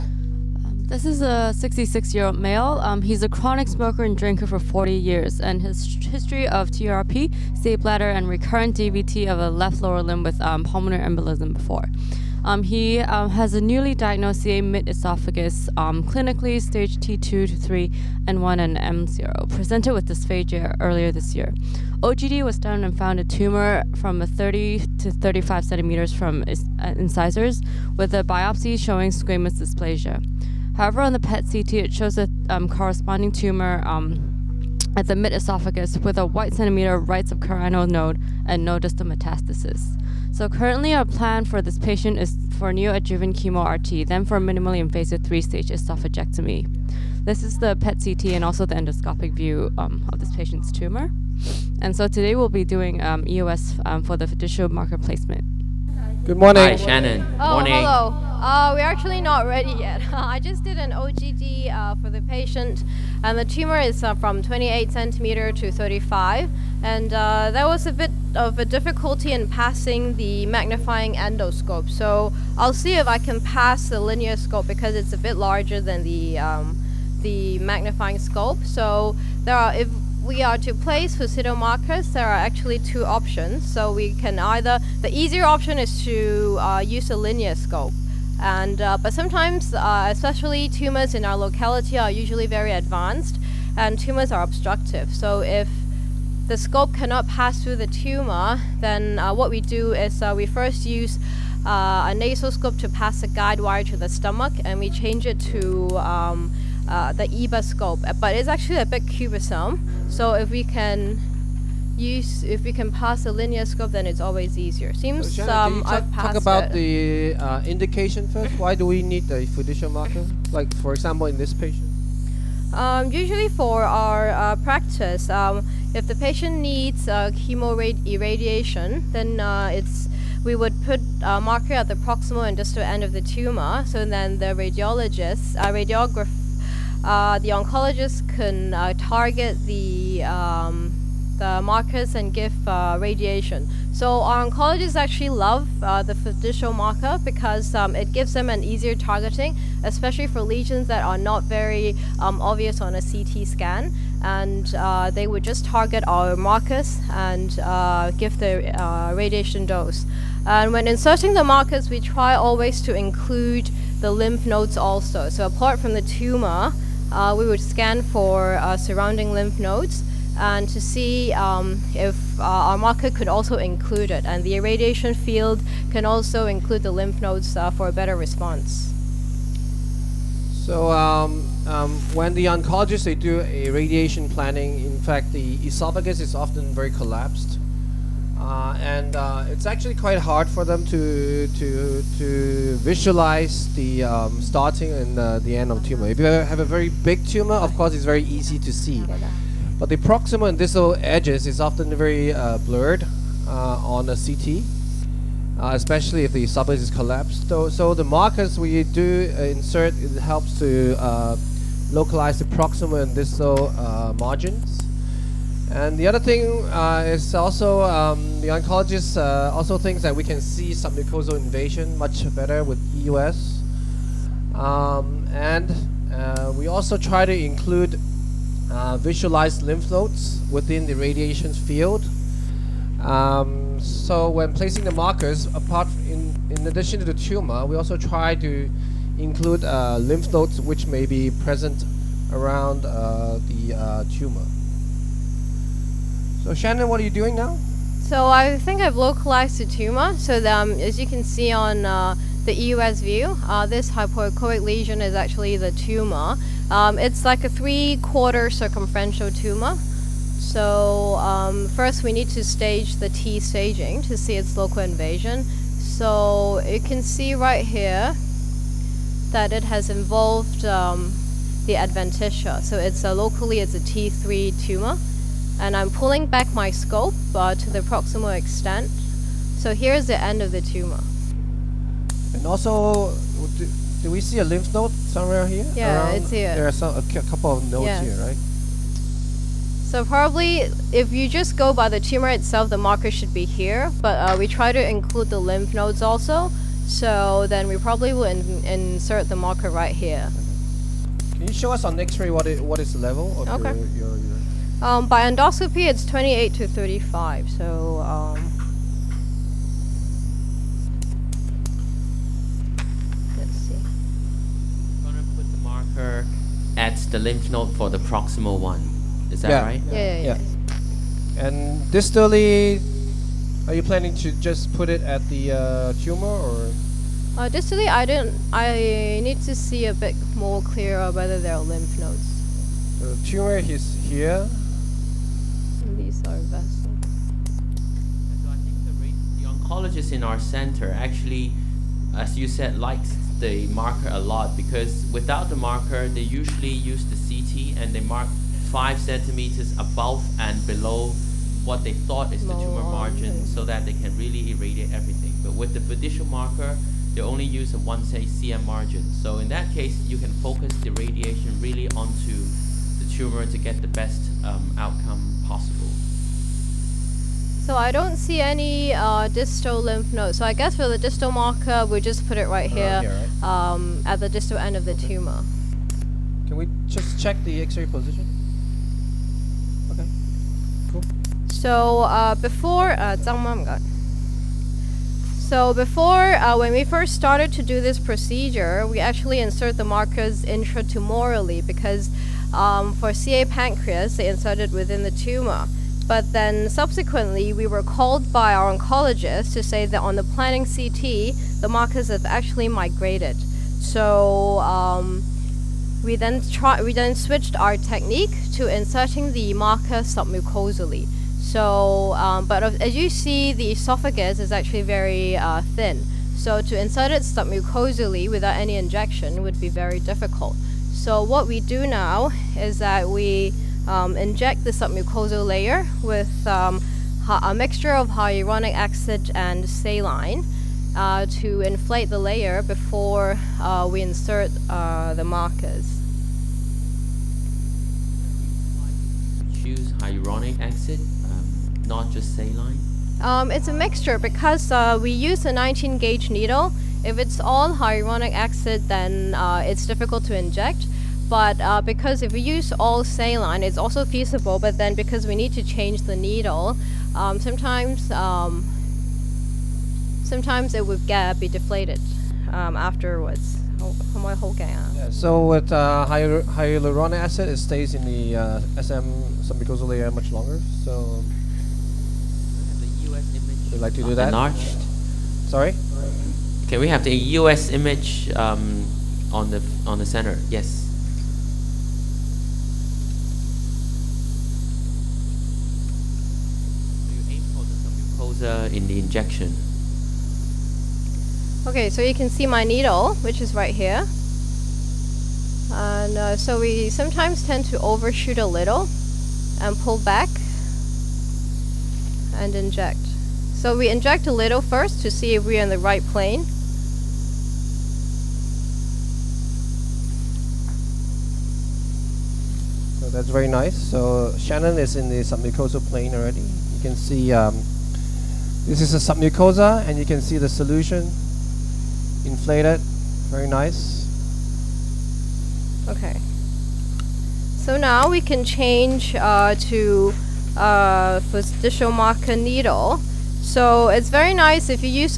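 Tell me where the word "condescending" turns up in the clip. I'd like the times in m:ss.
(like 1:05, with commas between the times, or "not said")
not said.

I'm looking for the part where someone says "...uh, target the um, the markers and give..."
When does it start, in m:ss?
2:18.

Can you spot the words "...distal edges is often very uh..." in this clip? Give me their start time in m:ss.
3:20.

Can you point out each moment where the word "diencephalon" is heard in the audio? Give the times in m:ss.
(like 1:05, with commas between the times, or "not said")
not said.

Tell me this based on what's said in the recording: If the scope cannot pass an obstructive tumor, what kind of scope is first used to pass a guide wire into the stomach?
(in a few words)
Nasal scope.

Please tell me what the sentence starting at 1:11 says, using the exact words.
So I'll see if I can pass the linear scope because it's a bit larger than the um, the magnifying scope.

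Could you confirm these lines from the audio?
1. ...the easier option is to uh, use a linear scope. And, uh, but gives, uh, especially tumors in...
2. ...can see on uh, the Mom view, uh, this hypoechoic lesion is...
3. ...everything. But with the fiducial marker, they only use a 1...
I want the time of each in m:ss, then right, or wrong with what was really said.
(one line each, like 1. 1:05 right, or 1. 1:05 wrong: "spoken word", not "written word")
1. 1:25 wrong: "sometimes", not "gives"
2. 4:11 wrong: "EUS", not "Mom"
3. 5:54 right.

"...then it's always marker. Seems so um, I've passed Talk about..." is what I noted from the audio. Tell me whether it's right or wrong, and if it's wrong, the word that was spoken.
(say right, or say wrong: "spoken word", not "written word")
wrong: "easier", not "marker".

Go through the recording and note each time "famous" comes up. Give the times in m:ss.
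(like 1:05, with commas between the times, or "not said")
not said.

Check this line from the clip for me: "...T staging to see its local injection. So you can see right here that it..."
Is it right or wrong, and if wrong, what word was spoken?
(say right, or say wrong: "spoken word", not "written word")
wrong: "invasion", not "injection".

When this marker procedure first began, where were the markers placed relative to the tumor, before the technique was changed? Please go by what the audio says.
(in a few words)
Intratumorally.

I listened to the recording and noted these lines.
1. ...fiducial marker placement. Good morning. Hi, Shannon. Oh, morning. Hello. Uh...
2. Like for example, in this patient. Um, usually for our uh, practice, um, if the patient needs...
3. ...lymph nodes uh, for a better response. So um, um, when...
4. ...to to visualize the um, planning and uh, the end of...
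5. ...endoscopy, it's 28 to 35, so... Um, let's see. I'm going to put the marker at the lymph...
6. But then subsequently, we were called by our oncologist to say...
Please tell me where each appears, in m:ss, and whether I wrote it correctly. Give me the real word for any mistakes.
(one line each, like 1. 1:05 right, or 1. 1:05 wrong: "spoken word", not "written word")
1. 0:54 right
2. 2:00 right
3. 2:56 right
4. 3:11 wrong: "starting", not "planning"
5. 5:05 right
6. 6:36 right.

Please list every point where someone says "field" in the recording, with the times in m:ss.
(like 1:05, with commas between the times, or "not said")
2:55, 3:51.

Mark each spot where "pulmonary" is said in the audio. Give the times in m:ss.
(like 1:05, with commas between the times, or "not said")
0:10.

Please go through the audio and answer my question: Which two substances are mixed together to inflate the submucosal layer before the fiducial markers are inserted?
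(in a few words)
Hyaluronic acid and saline.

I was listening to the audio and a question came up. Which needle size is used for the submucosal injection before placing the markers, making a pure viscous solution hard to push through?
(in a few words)
19 gauge.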